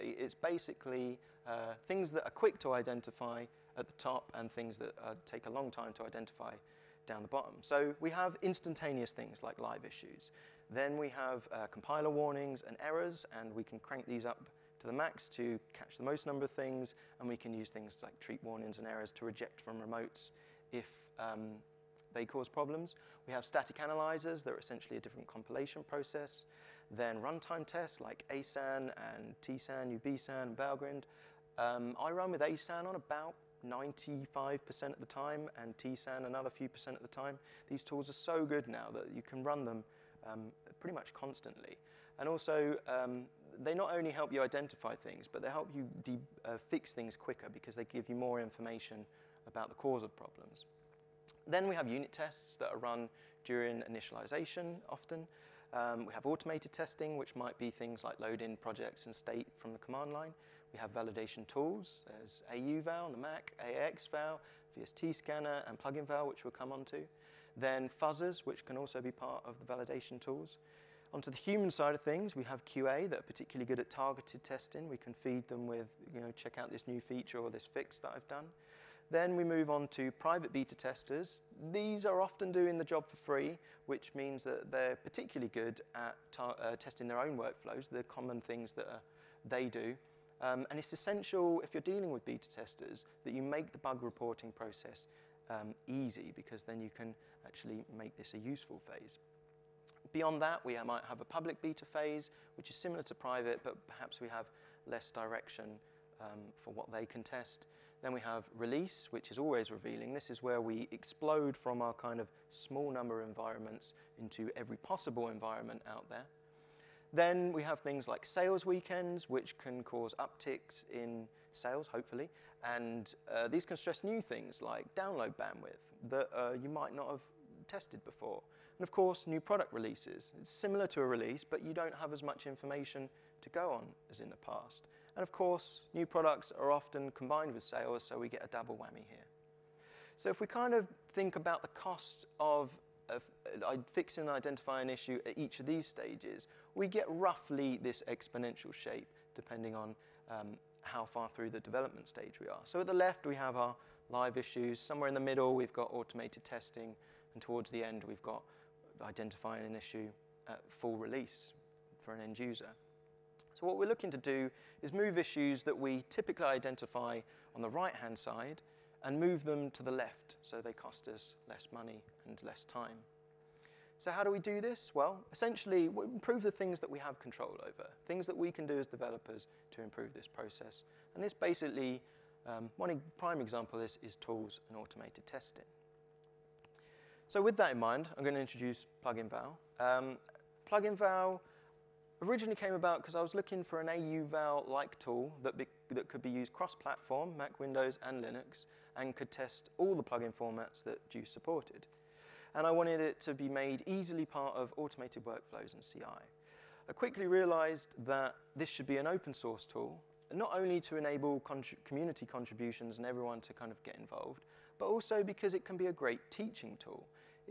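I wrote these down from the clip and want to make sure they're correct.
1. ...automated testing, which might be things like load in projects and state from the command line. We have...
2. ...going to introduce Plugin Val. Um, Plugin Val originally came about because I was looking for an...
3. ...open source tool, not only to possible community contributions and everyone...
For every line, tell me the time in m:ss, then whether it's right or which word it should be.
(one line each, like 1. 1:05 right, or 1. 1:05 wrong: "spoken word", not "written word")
1. 0:56 right
2. 3:08 right
3. 3:29 wrong: "enable", not "possible".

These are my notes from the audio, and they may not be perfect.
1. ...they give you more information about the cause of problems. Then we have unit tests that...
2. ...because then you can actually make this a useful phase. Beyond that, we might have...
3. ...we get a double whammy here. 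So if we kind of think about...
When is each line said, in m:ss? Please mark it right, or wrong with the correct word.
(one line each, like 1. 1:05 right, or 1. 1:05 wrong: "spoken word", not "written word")
1. 0:47 right
2. 1:36 right
3. 2:18 right.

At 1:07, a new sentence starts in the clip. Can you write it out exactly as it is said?
Then fuzzers, which can also be part of the validation tools.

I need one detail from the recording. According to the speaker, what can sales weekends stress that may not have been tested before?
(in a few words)
Download bandwidth.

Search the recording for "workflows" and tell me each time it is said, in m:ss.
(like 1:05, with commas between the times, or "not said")
1:27, 3:25.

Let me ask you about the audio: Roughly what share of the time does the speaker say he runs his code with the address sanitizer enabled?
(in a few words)
95%.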